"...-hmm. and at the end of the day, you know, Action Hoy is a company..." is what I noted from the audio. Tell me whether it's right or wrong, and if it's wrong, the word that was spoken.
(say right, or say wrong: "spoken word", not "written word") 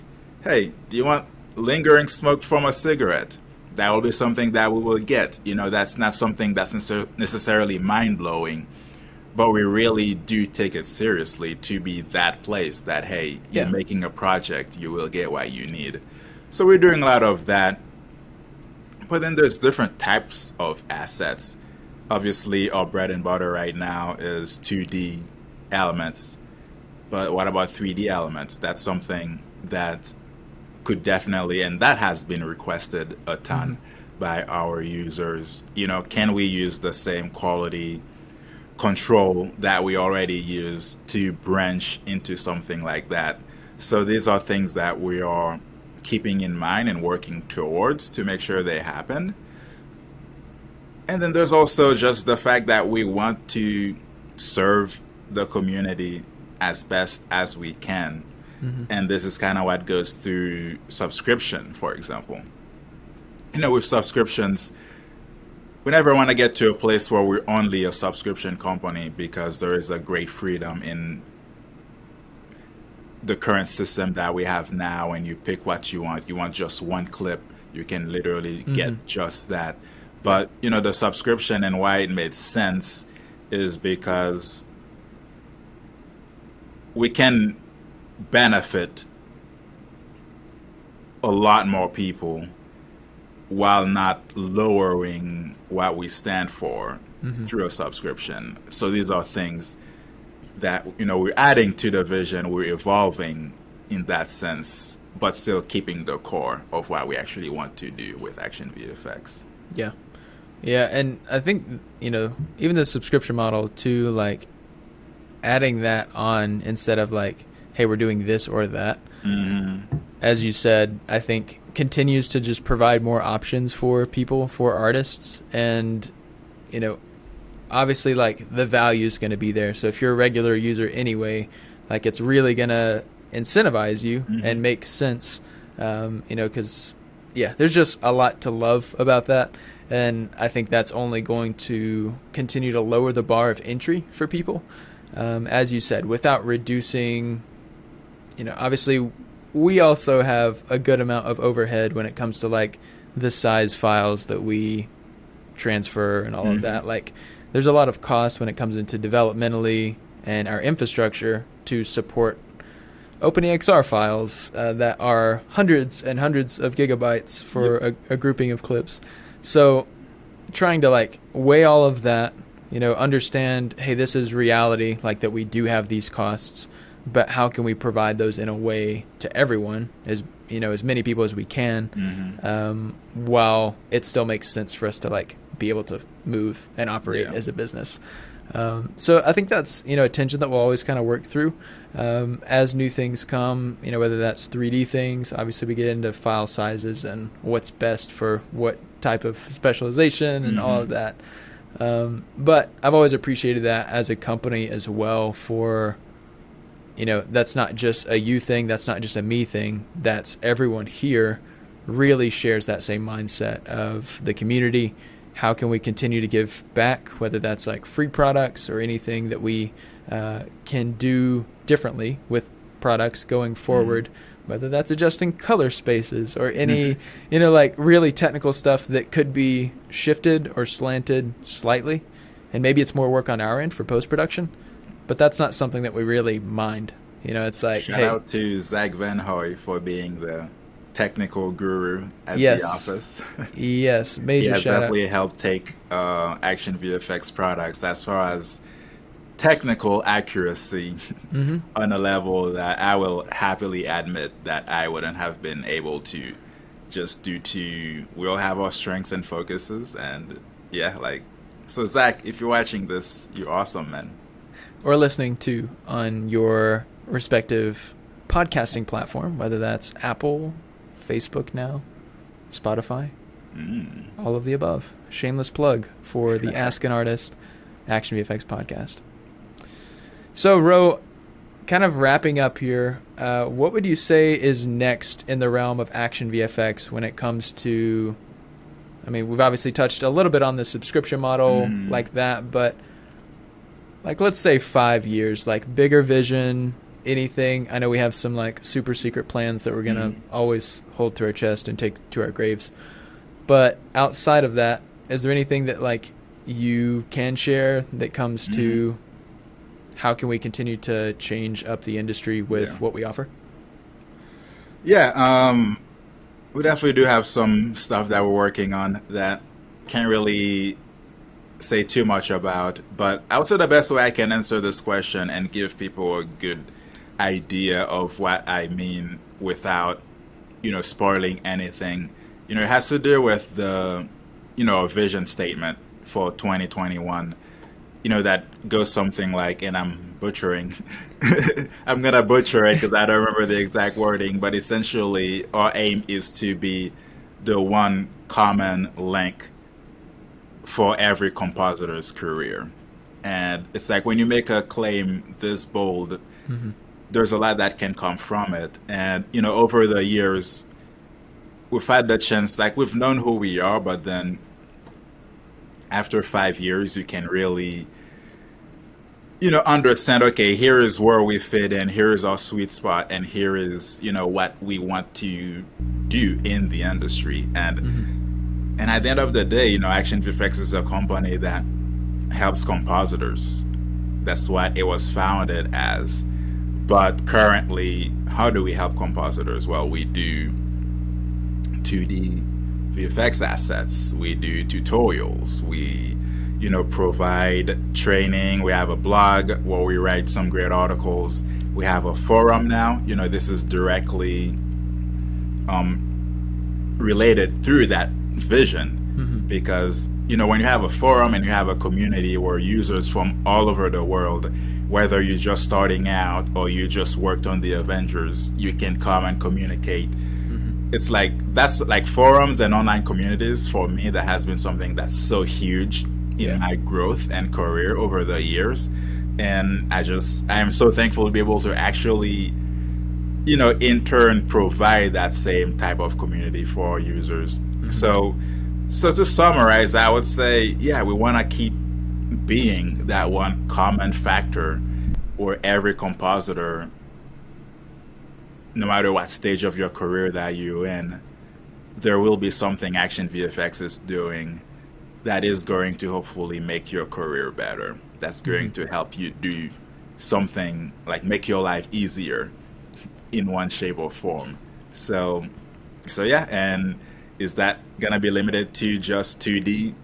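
wrong: "VFX", not "Hoy".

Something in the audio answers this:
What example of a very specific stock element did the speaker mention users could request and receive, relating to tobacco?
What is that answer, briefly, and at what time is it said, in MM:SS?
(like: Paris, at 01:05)
Lingering smoke from a cigarette, at 00:01.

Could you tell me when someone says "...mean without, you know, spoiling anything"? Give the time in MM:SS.
05:28.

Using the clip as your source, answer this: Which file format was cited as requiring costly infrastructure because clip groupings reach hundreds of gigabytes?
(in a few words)
OpenEXR.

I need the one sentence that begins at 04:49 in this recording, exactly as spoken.
I mean, we've obviously touched a little bit on the subscription model mm.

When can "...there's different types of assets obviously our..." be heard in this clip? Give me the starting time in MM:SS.
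00:19.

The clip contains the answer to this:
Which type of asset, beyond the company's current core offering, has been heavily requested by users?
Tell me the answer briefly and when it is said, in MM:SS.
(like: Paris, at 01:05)
3D elements, at 00:27.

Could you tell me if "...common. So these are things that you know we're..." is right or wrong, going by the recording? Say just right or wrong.
wrong.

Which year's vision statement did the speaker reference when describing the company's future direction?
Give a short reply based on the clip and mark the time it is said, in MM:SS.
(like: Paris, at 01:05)
2021, at 05:36.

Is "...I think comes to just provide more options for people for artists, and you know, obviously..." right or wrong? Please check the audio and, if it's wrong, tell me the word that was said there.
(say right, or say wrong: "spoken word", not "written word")
wrong: "continues", not "comes".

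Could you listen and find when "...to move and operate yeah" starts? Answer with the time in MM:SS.
03:05.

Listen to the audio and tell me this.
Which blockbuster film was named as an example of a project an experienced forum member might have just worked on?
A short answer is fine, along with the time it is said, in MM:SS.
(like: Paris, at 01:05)
The Avengers, at 06:57.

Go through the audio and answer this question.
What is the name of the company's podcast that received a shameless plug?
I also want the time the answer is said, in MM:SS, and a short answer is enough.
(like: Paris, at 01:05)
Ask an Artist, at 04:36.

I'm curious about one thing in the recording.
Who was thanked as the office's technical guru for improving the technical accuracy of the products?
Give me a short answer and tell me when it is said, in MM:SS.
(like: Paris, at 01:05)
Zach Van Hoy, at 03:58.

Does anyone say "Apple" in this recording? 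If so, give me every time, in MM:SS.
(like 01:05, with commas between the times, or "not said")
04:30.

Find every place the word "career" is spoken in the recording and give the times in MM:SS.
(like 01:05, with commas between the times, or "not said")
05:52, 07:07, 07:29, 07:37.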